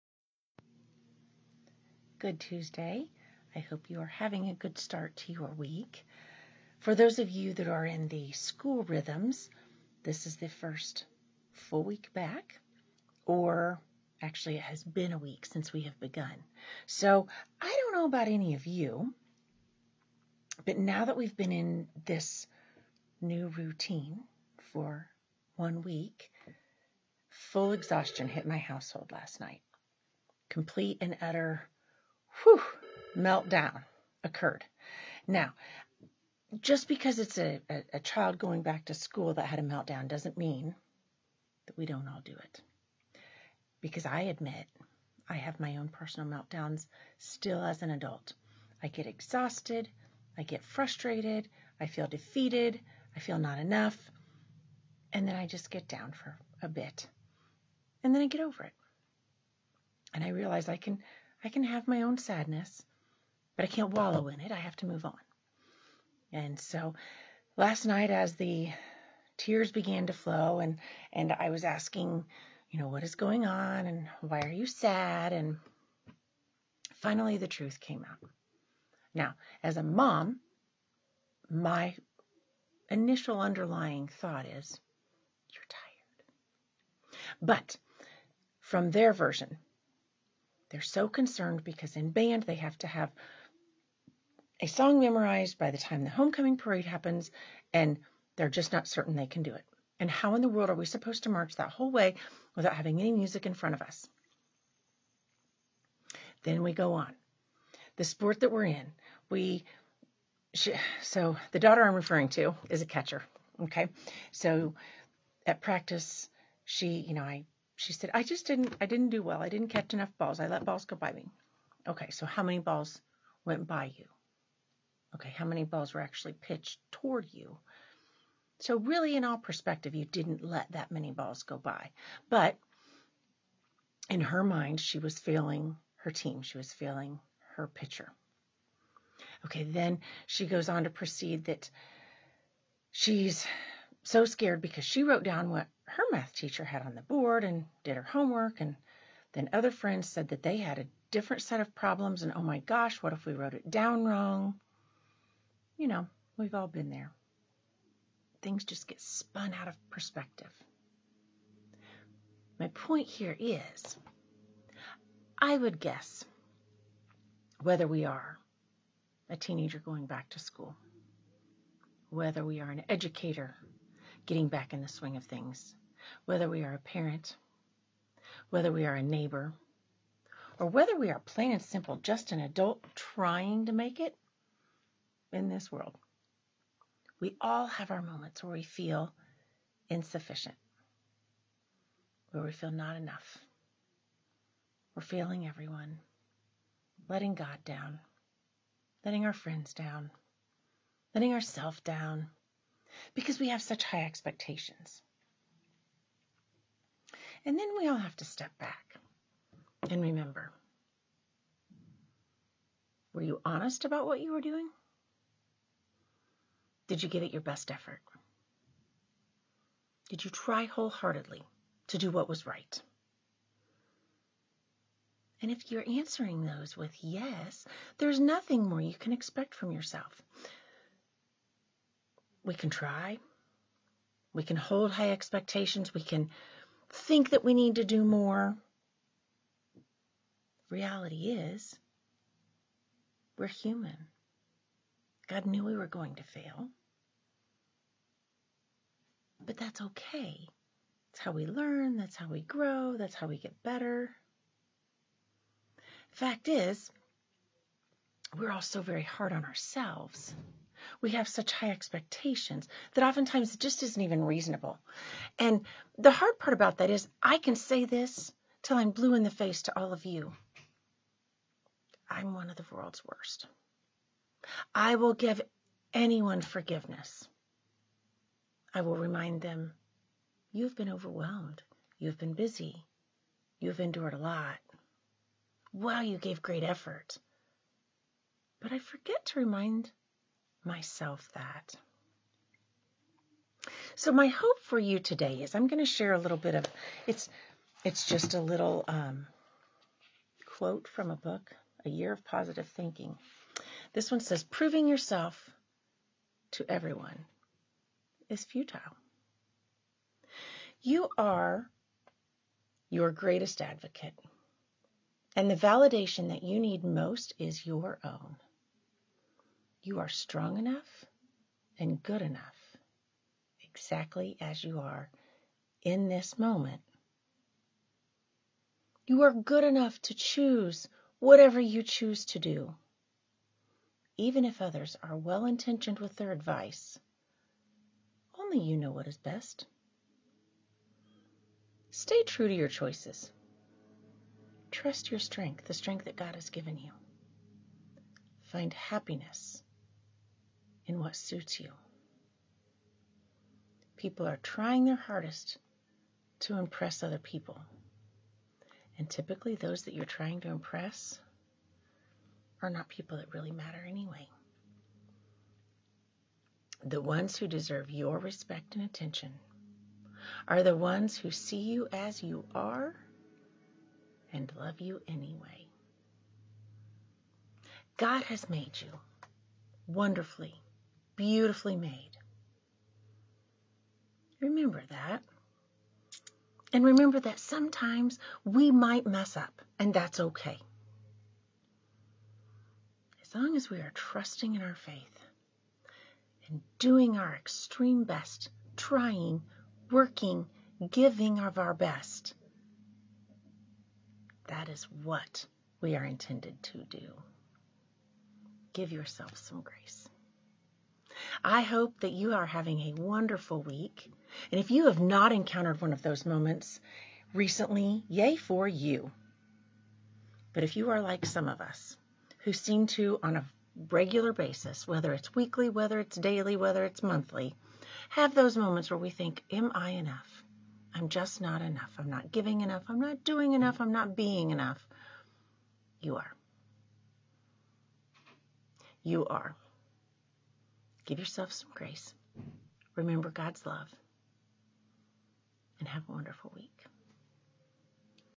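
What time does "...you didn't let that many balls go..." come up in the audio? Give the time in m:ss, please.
2:09.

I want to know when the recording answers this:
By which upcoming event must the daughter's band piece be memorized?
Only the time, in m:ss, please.
1:36.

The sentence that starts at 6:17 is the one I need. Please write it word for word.
God has made you wonderfully, beautifully made.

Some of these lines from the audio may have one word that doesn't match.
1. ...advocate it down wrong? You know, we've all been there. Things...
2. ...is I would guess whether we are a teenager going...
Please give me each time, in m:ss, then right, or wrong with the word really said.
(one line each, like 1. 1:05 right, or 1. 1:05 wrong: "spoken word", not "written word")
1. 2:33 wrong: "wrote", not "advocate"
2. 2:43 right.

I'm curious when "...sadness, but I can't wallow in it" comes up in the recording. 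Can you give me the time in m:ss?
1:02.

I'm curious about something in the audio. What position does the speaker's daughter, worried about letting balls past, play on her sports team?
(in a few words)
catcher.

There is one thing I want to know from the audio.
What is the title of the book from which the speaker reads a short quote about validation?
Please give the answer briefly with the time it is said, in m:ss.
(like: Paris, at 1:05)
A Year of Positive Thinking, at 5:01.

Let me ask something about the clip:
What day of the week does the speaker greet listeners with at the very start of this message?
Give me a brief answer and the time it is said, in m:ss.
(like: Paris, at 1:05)
Tuesday, at 0:02.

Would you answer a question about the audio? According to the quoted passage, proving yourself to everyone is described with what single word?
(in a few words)
futile.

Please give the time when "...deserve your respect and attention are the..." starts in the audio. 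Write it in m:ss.
6:07.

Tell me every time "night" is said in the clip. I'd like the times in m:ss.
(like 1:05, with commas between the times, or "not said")
0:29, 1:07.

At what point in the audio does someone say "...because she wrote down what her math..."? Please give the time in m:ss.
2:24.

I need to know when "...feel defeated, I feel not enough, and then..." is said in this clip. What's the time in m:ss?
0:51.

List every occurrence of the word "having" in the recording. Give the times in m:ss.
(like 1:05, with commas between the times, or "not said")
0:04, 1:42, 6:52.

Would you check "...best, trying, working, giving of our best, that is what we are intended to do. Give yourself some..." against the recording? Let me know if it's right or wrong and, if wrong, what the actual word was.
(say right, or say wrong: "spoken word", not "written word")
right.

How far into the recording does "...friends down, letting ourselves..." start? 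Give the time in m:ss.
3:19.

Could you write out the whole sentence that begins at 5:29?
You are good enough to choose whatever you choose to do.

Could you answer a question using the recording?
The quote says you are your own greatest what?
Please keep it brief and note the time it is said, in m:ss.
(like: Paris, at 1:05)
advocate, at 5:13.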